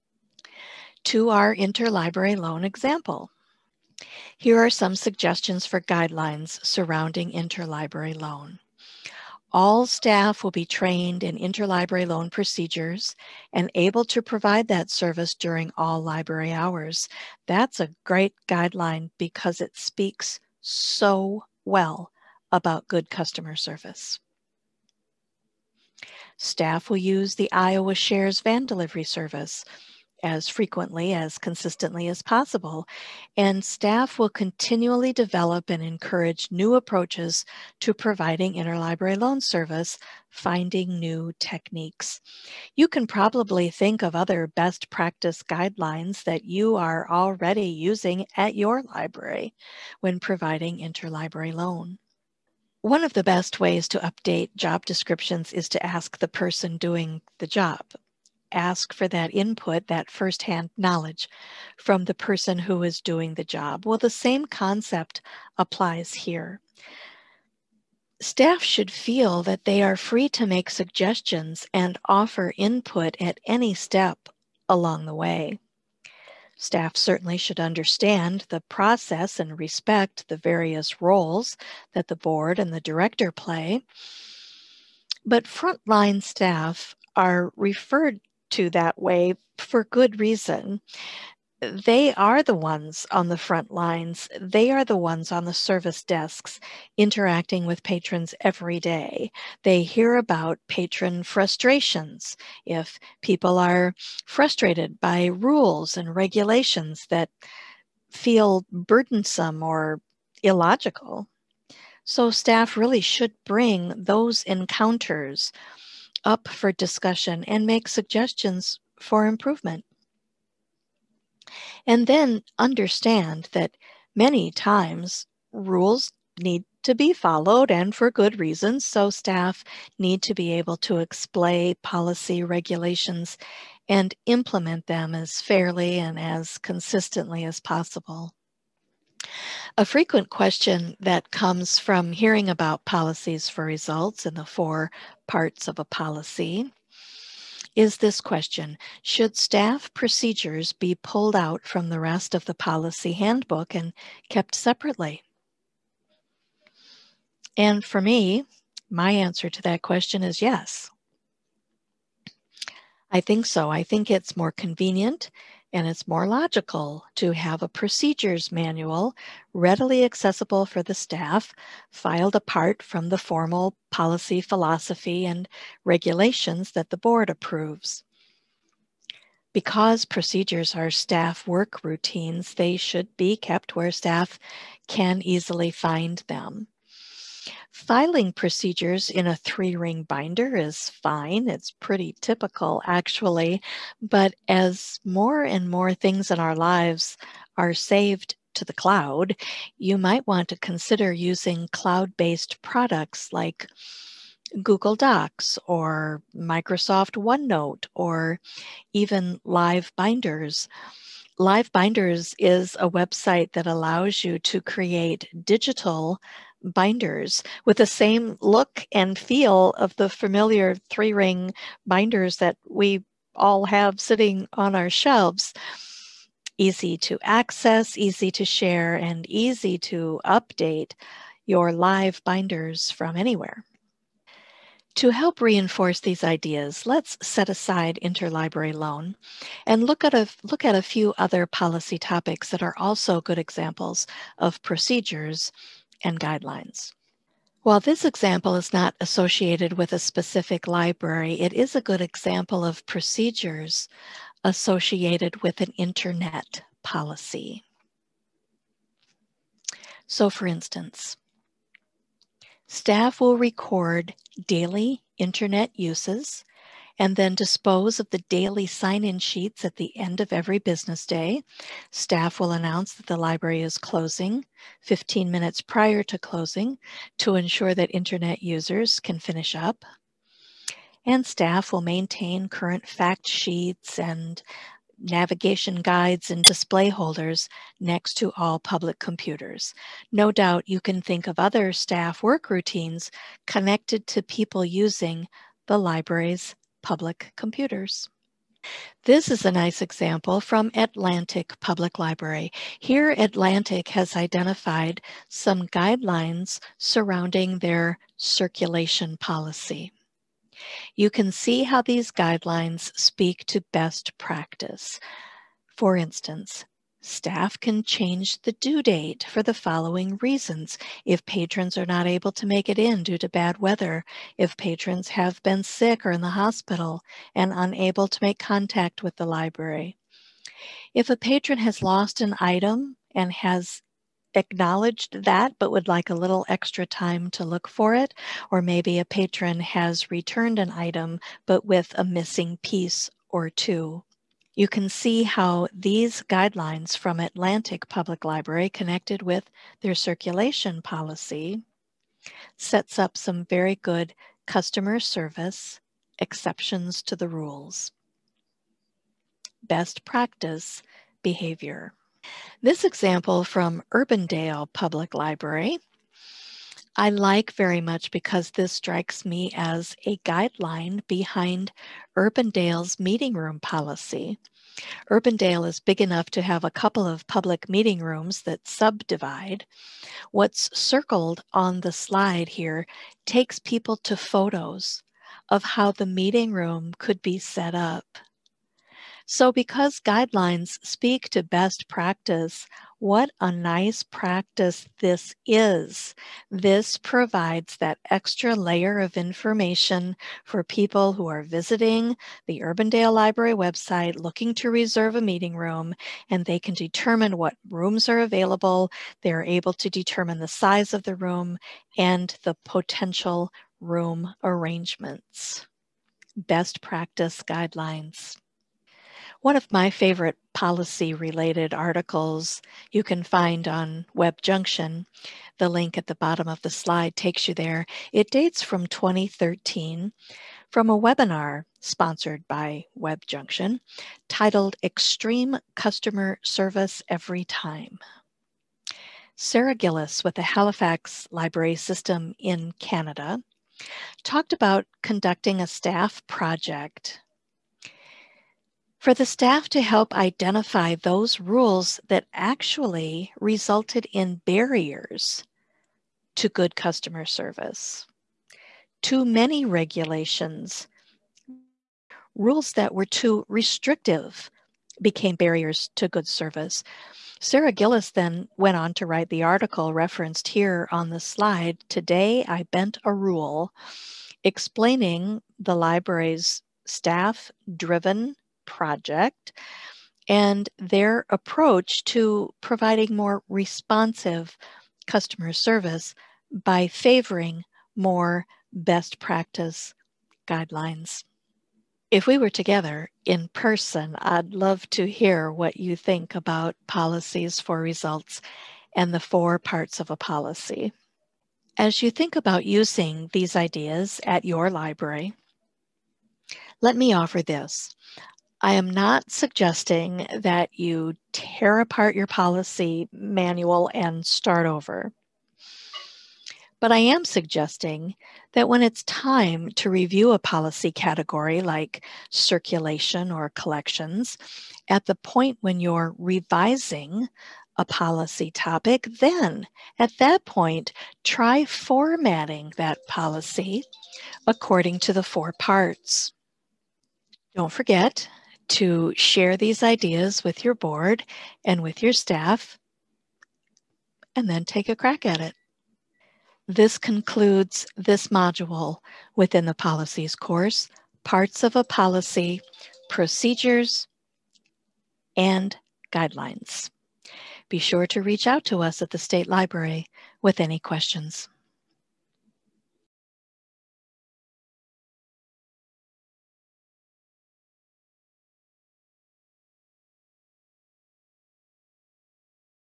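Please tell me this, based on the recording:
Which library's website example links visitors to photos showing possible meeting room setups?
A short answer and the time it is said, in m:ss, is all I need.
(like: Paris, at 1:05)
Urbandale Public Library, at 6:03.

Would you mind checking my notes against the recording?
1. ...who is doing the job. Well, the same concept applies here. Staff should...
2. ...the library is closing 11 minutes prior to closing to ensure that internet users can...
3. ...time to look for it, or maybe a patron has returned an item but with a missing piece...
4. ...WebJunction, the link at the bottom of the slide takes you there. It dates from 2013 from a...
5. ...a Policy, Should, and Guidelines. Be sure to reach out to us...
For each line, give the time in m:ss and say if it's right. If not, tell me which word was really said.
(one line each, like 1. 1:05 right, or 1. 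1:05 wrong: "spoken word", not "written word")
1. 1:02 right
2. 4:33 wrong: "15", not "11"
3. 5:36 right
4. 7:04 right
5. 9:11 wrong: "Procedures", not "Should".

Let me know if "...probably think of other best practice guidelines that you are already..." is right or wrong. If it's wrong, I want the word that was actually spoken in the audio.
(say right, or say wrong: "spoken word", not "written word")
right.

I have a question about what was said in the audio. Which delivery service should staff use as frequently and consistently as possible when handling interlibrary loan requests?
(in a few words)
Iowa Shares van delivery.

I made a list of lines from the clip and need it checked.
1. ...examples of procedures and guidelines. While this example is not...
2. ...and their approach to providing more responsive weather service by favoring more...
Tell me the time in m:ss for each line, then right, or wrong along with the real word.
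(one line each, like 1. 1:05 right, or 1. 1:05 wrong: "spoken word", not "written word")
1. 4:03 right
2. 8:00 wrong: "customer", not "weather".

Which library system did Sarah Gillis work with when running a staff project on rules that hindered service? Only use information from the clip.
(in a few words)
Halifax Library System.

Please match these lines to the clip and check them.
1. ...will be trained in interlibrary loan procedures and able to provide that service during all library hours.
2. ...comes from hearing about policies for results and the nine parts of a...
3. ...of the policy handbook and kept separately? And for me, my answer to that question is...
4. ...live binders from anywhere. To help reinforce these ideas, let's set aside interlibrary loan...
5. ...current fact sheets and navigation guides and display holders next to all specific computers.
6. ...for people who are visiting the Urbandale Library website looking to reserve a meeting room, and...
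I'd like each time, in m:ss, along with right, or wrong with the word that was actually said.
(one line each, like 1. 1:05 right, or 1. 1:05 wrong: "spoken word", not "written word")
1. 0:10 right
2. 2:21 wrong: "four", not "nine"
3. 2:32 right
4. 3:51 right
5. 4:42 wrong: "public", not "specific"
6. 6:40 right.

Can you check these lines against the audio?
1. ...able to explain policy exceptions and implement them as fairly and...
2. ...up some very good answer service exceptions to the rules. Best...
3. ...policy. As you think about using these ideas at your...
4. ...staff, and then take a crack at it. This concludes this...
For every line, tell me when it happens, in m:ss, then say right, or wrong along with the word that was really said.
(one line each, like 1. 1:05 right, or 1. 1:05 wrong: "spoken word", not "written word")
1. 2:10 wrong: "regulations", not "exceptions"
2. 5:52 wrong: "customer", not "answer"
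3. 8:20 right
4. 9:02 right.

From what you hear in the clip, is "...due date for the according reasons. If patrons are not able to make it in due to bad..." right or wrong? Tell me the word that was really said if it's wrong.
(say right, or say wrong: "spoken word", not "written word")
wrong: "following", not "according".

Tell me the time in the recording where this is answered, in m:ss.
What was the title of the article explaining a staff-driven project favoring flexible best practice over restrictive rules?
7:51.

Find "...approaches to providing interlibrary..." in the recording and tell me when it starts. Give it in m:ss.
0:36.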